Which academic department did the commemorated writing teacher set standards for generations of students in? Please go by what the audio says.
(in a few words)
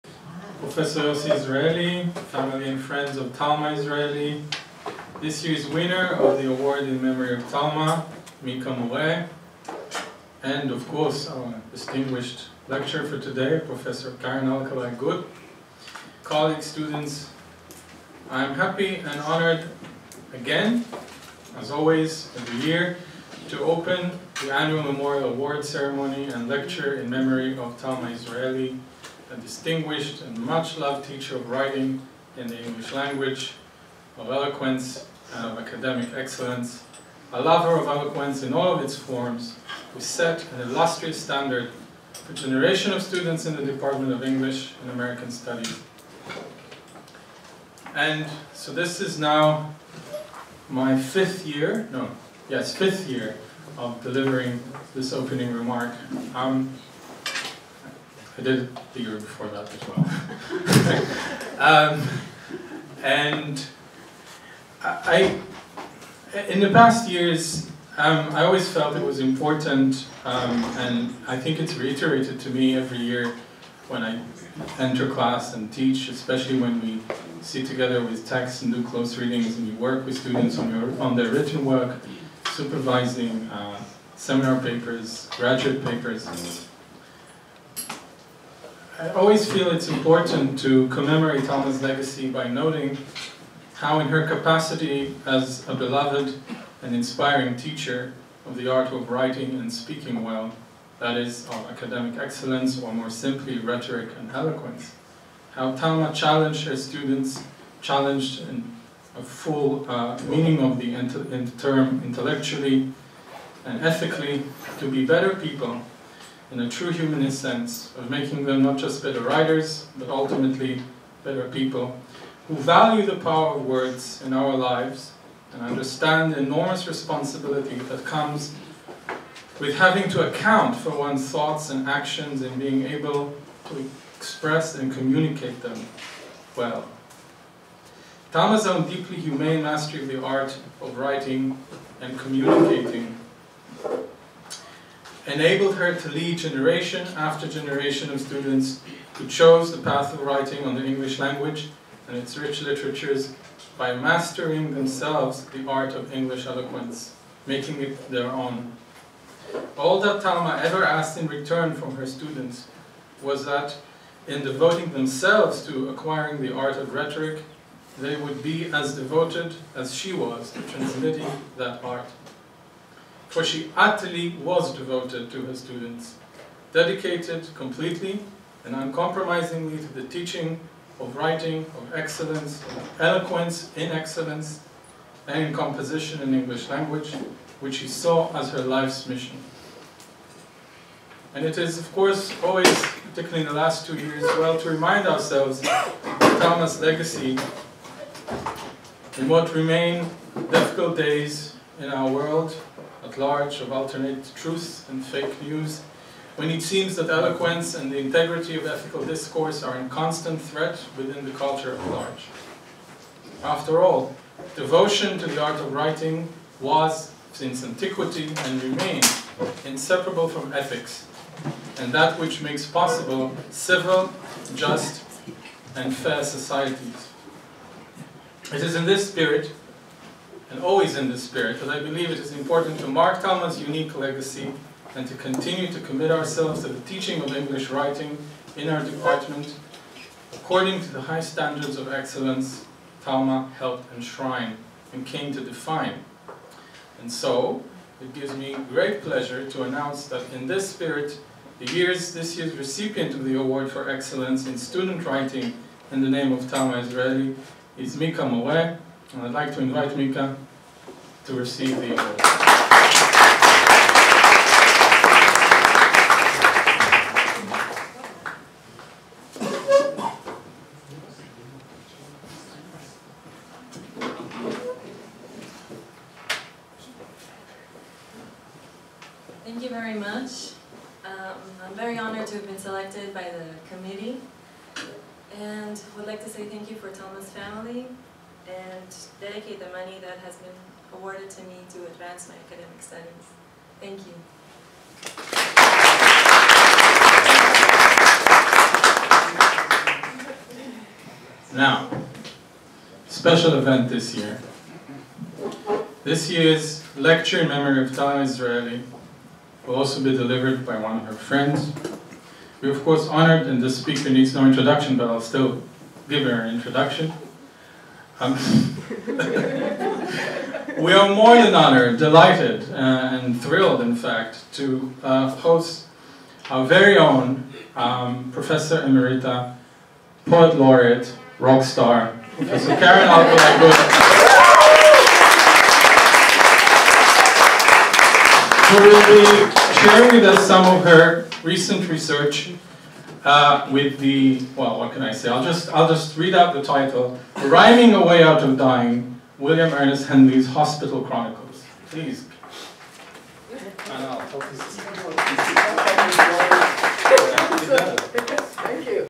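Department of English and American Studies.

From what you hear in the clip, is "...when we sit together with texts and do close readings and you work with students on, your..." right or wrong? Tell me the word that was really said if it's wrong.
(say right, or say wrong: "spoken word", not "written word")
right.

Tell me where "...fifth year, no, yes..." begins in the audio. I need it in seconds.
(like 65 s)
50 s.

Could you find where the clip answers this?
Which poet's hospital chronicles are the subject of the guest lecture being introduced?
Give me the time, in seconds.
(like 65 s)
349 s.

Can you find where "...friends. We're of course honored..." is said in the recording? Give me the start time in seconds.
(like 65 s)
311 s.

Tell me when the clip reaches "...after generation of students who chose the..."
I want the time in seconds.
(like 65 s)
147 s.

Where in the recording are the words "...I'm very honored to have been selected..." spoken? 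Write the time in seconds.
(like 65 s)
281 s.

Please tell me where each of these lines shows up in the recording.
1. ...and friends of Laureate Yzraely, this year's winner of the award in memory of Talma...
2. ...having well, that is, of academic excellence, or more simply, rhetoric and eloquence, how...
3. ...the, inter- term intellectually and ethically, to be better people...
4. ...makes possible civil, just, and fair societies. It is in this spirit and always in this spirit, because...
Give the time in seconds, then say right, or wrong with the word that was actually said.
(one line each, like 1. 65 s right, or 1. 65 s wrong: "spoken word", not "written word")
1. 2 s wrong: "Talma", not "Laureate"
2. 99 s wrong: "speaking", not "having"
3. 110 s right
4. 222 s right.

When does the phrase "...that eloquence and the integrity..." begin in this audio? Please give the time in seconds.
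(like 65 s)
206 s.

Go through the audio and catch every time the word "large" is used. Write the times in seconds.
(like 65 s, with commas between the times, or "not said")
203 s, 211 s.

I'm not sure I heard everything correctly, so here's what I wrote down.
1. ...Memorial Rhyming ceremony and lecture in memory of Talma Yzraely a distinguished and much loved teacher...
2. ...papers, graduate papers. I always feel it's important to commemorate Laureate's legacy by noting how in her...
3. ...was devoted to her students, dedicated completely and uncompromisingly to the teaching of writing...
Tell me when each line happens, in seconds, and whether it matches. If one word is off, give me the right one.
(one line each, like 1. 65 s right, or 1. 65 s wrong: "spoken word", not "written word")
1. 24 s wrong: "Award", not "Rhyming"
2. 84 s wrong: "Talma", not "Laureate"
3. 174 s right.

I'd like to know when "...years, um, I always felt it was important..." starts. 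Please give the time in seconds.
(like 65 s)
67 s.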